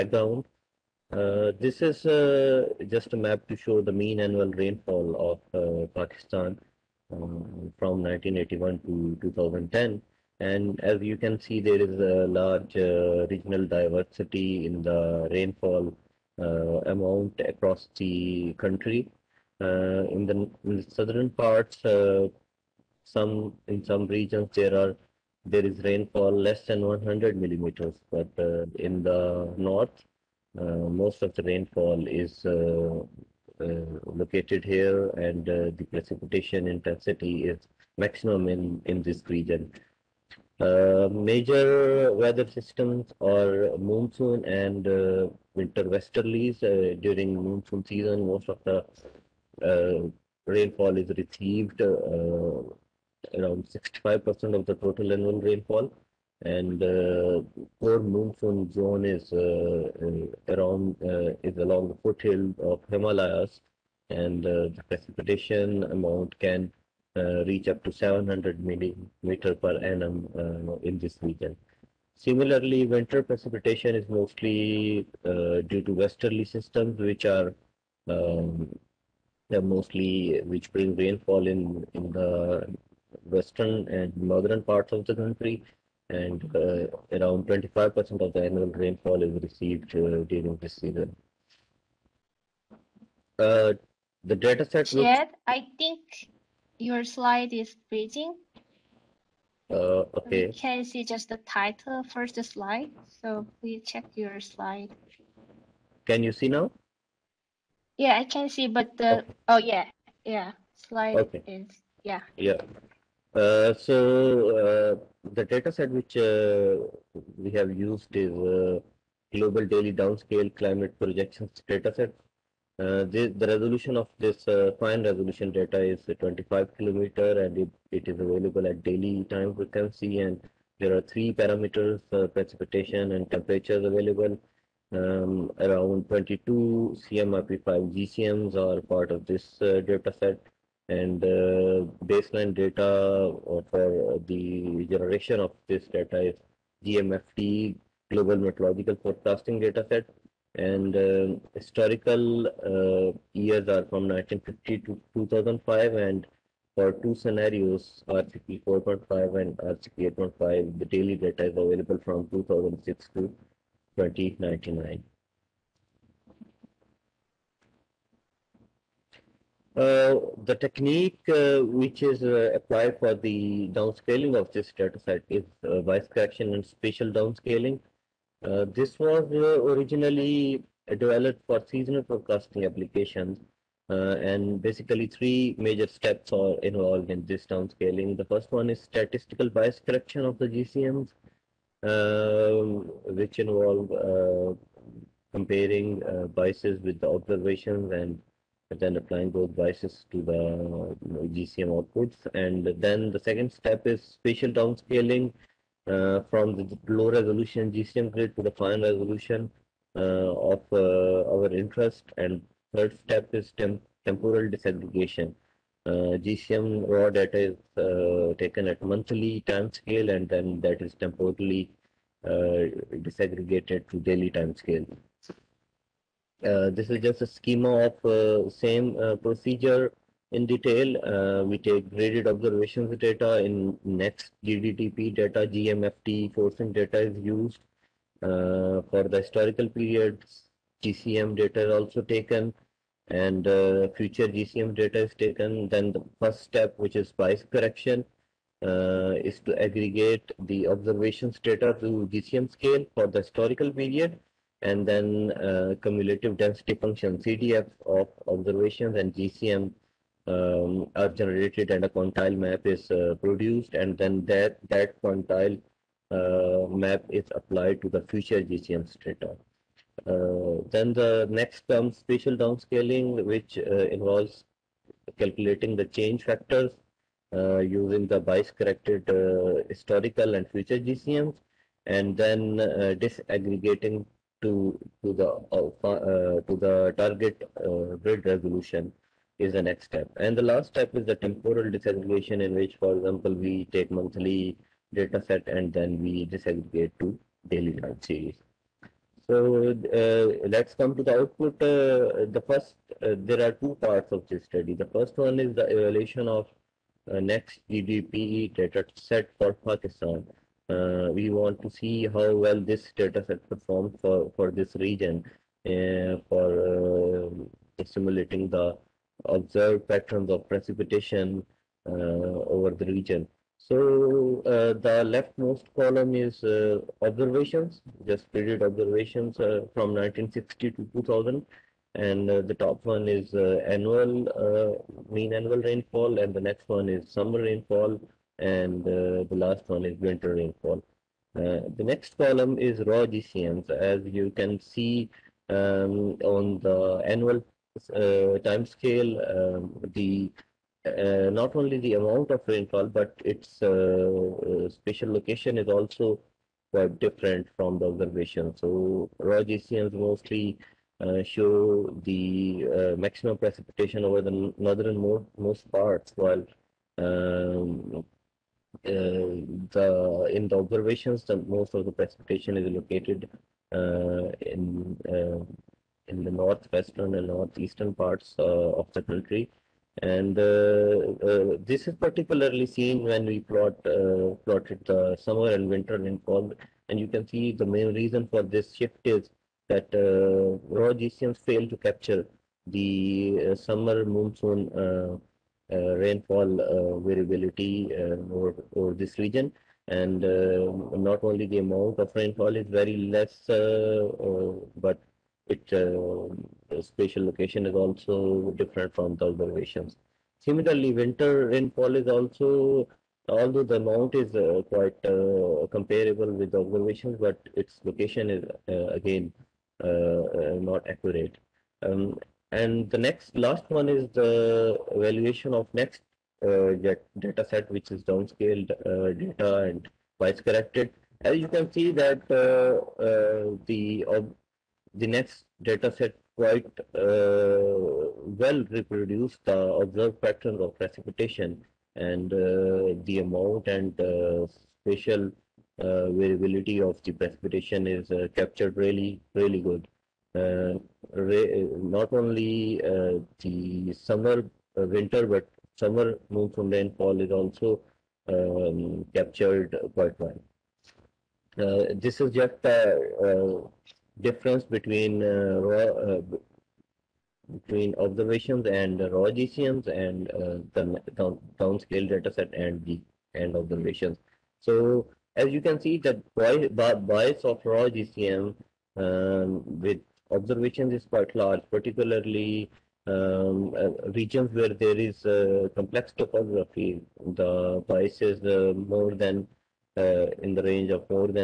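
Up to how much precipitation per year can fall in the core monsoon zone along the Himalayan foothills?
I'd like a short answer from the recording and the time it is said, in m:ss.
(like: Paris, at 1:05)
700 millimeters, at 1:07.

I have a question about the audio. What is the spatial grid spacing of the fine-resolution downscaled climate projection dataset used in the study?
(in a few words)
25 kilometers.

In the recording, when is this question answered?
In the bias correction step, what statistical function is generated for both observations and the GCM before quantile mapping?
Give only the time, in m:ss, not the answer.
4:15.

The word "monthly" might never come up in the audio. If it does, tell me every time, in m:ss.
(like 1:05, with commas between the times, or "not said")
3:38, 4:53.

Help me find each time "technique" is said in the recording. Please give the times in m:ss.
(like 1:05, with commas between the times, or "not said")
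2:50.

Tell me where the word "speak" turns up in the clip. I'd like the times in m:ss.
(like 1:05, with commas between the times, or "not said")
not said.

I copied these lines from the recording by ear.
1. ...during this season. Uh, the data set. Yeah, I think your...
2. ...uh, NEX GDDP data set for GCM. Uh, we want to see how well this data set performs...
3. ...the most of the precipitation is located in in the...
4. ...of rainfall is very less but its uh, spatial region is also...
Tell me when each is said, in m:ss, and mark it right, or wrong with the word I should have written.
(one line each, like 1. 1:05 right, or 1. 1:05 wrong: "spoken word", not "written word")
1. 1:30 right
2. 5:07 wrong: "Pakistan", not "GCM"
3. 6:11 right
4. 6:41 wrong: "location", not "region".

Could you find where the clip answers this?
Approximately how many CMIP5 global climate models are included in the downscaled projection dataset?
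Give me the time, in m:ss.
2:16.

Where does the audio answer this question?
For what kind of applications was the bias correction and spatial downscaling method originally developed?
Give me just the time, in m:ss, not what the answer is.
3:01.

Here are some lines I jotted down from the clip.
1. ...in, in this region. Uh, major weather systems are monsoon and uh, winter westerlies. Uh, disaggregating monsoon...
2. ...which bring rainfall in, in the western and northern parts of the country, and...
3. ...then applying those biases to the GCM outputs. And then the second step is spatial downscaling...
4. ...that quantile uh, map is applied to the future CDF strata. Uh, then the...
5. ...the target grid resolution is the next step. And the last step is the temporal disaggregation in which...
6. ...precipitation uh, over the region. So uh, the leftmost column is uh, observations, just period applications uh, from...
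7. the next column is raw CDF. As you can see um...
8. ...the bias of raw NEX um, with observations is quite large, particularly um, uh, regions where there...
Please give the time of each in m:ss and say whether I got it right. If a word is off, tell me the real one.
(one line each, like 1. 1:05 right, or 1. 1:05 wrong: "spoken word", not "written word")
1. 0:38 wrong: "during", not "disaggregating"
2. 1:20 right
3. 3:18 right
4. 4:24 wrong: "GCM", not "CDF"
5. 4:46 right
6. 5:20 wrong: "observations", not "applications"
7. 5:41 wrong: "GCMs", not "CDF"
8. 7:55 wrong: "GCM", not "NEX".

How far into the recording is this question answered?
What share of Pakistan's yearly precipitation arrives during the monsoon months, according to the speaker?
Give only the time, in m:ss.
0:53.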